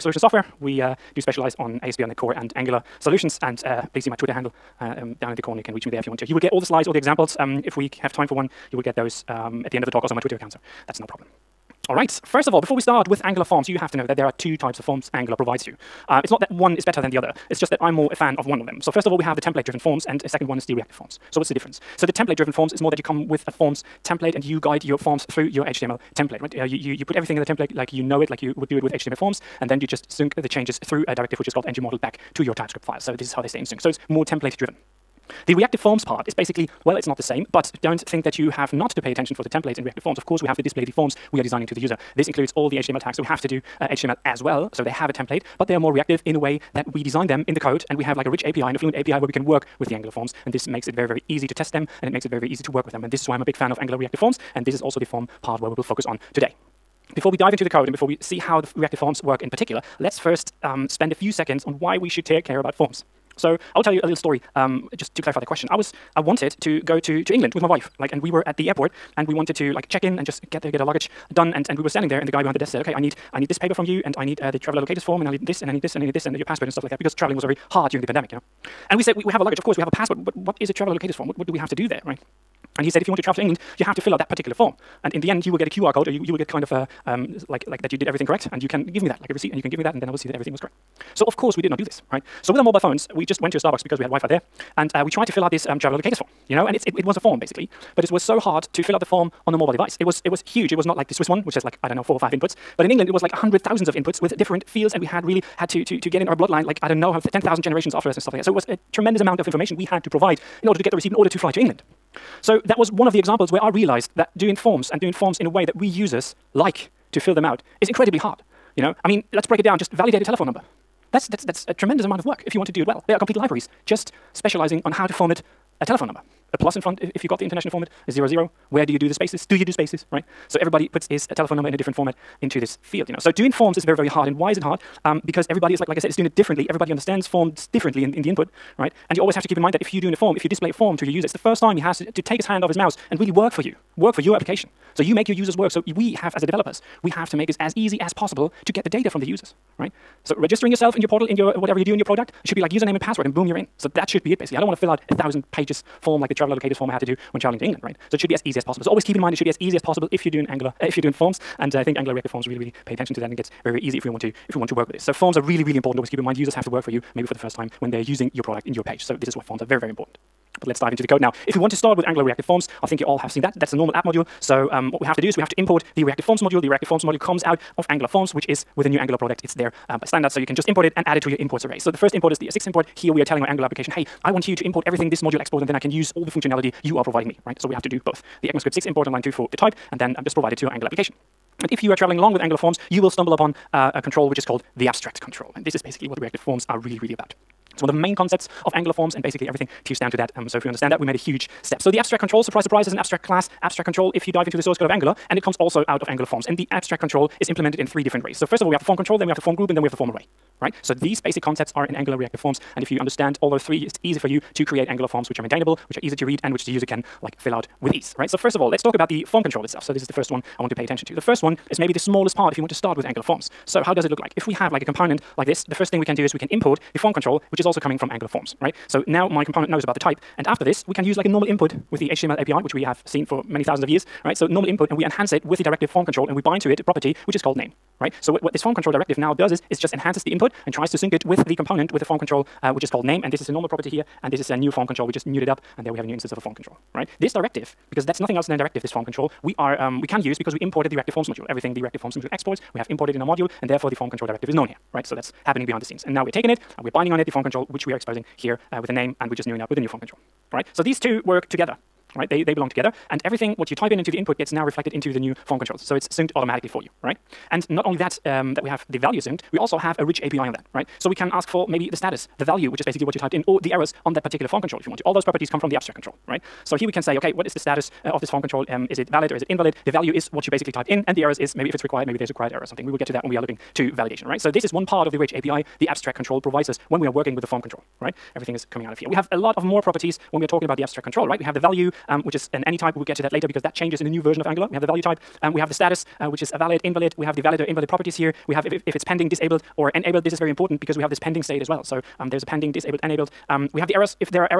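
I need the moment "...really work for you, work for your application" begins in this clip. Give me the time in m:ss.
2:23.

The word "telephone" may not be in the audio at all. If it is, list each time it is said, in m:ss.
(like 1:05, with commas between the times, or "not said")
2:00, 2:05, 2:11.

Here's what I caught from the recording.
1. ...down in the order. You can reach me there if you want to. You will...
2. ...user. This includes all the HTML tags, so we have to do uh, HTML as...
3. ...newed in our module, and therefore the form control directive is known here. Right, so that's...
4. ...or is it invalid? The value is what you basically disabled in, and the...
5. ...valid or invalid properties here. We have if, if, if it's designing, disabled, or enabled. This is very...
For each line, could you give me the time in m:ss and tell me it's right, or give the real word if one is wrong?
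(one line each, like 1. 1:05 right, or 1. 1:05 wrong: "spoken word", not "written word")
1. 0:05 wrong: "corner", not "order"
2. 0:41 right
3. 4:12 wrong: "imported", not "newed"
4. 4:39 wrong: "typed", not "disabled"
5. 4:57 wrong: "pending", not "designing".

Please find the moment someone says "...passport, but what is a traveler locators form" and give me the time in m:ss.
1:19.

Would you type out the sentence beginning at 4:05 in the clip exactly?
We just newed it up, and there we have a new instance of a form control, right?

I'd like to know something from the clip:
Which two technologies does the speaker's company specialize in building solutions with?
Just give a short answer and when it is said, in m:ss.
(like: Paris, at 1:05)
ASP.NET Core and Angular, at 0:01.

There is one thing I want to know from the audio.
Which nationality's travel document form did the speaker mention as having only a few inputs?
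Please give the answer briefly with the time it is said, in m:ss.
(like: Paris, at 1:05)
Swiss, at 1:41.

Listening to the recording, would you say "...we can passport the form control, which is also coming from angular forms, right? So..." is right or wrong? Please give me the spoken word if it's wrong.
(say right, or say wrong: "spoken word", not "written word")
wrong: "import", not "passport".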